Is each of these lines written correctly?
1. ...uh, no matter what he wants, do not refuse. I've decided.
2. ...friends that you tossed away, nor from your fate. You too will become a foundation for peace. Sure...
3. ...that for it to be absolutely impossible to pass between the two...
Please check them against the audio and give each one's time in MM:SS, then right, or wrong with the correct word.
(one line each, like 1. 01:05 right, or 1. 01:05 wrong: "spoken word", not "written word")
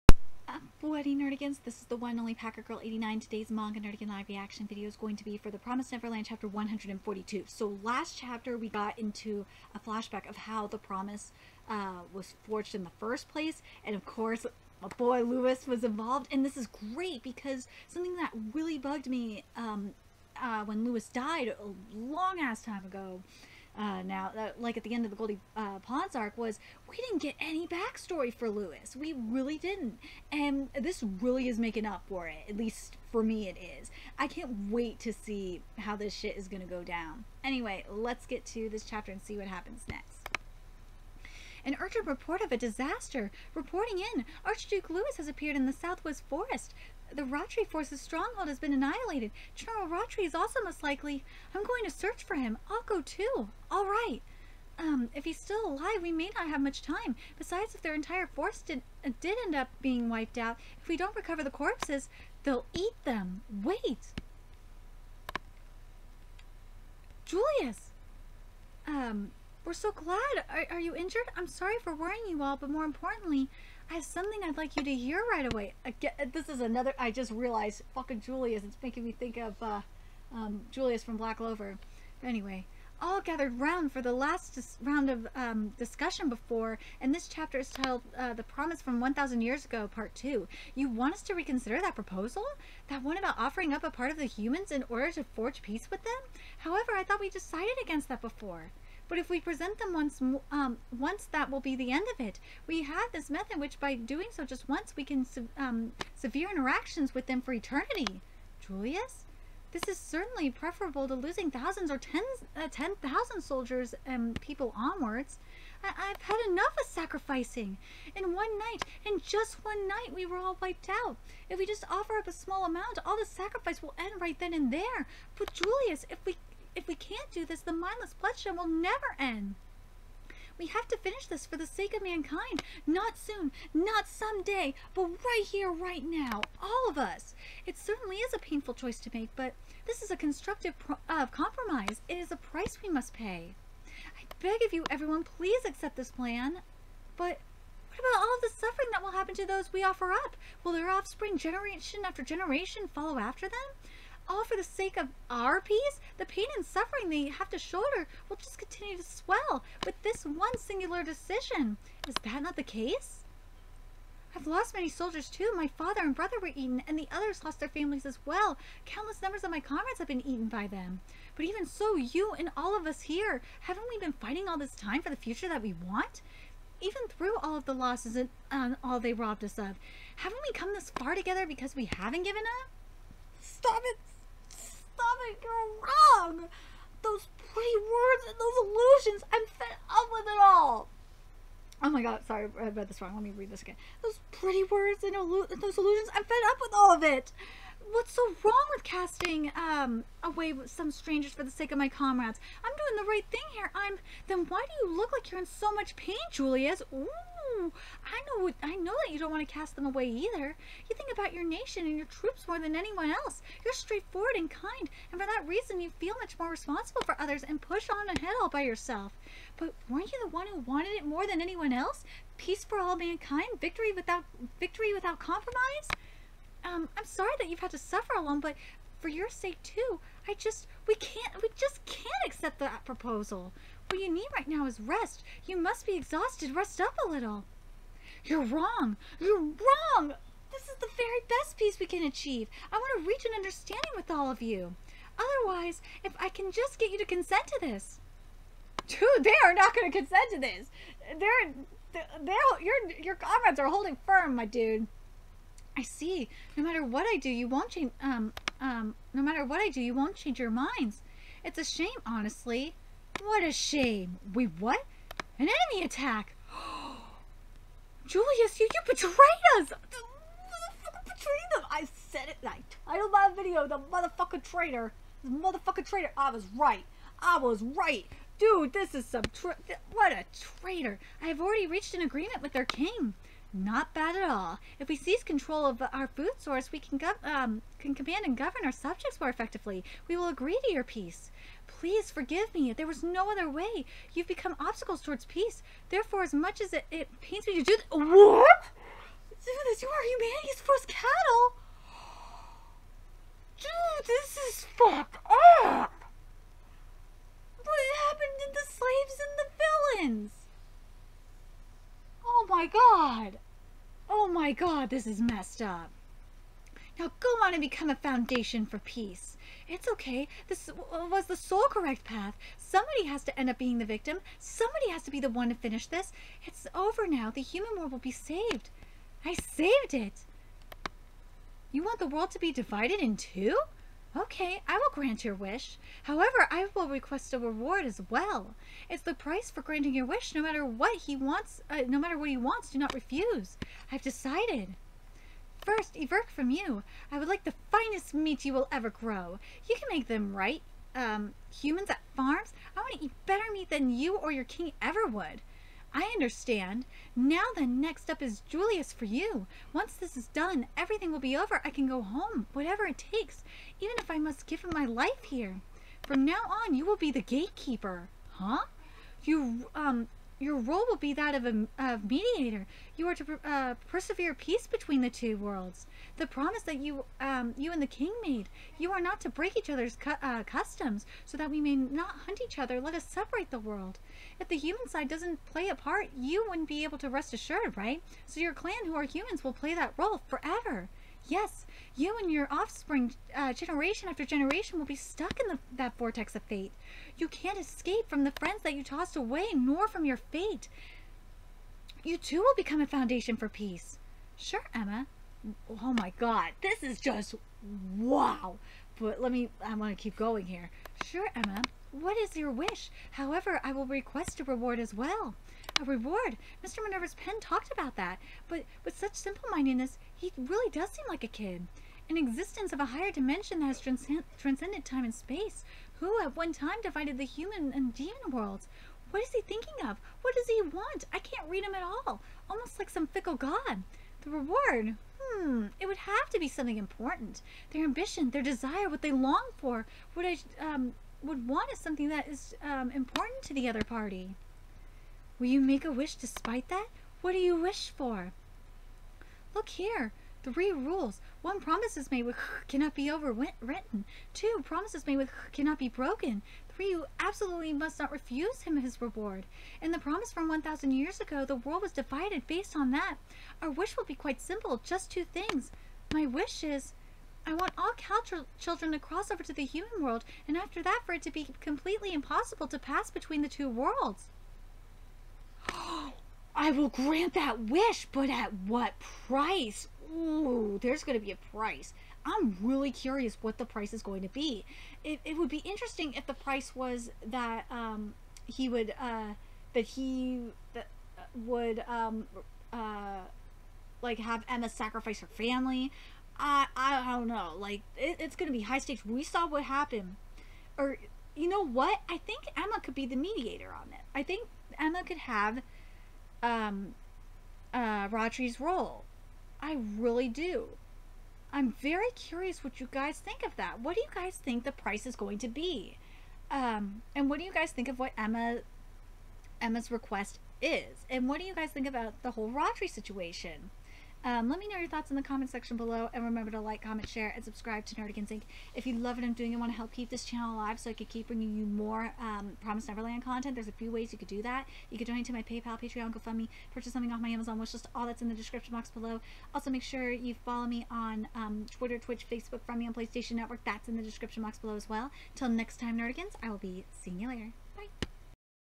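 1. 05:41 right
2. 06:38 right
3. 07:50 wrong: "completely", not "absolutely".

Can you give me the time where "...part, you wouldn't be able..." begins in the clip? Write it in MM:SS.
06:25.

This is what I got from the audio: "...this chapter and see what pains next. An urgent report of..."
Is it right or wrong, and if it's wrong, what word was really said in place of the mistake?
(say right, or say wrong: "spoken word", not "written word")
wrong: "happens", not "pains".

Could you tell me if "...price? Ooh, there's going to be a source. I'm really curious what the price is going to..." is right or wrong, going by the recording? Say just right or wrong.
wrong.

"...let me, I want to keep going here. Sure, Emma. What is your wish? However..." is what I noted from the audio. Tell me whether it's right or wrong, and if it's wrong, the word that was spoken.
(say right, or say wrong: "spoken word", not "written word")
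right.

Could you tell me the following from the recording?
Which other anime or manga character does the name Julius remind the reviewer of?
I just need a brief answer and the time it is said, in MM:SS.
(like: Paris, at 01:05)
Black Clover, at 01:21.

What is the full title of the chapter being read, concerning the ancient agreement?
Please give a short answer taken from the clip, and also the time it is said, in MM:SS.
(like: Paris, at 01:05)
The Promise from 1,000 Years Ago, Part 2, at 01:28.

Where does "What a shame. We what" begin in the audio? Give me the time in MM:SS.
04:23.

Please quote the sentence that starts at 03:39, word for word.
But weren't you the one who wanted it more than anyone else?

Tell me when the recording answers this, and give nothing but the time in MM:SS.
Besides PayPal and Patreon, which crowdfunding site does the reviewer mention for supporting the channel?
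08:56.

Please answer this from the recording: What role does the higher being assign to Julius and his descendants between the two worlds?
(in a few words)
gatekeeper.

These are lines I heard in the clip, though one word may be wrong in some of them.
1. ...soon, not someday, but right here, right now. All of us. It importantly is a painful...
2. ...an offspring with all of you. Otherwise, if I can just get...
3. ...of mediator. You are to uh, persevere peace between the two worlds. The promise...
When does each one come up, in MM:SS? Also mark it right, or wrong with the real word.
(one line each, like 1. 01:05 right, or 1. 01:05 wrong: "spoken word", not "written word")
1. 02:13 wrong: "certainly", not "importantly"
2. 04:03 wrong: "understanding", not "offspring"
3. 06:11 right.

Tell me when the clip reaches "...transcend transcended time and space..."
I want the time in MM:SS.
07:03.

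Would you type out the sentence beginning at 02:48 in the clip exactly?
Countless numbers of my comrades have been eaten by them.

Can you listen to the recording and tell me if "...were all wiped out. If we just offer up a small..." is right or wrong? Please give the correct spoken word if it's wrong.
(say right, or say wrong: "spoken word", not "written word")
right.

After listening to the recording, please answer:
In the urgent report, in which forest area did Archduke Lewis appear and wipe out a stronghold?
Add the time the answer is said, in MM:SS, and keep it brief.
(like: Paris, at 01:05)
Southwest Forest, at 00:45.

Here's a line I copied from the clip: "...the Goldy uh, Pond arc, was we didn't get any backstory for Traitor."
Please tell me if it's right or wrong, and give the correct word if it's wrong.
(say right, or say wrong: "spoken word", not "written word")
wrong: "Lewis", not "Traitor".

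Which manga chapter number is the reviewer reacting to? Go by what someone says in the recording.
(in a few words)
142.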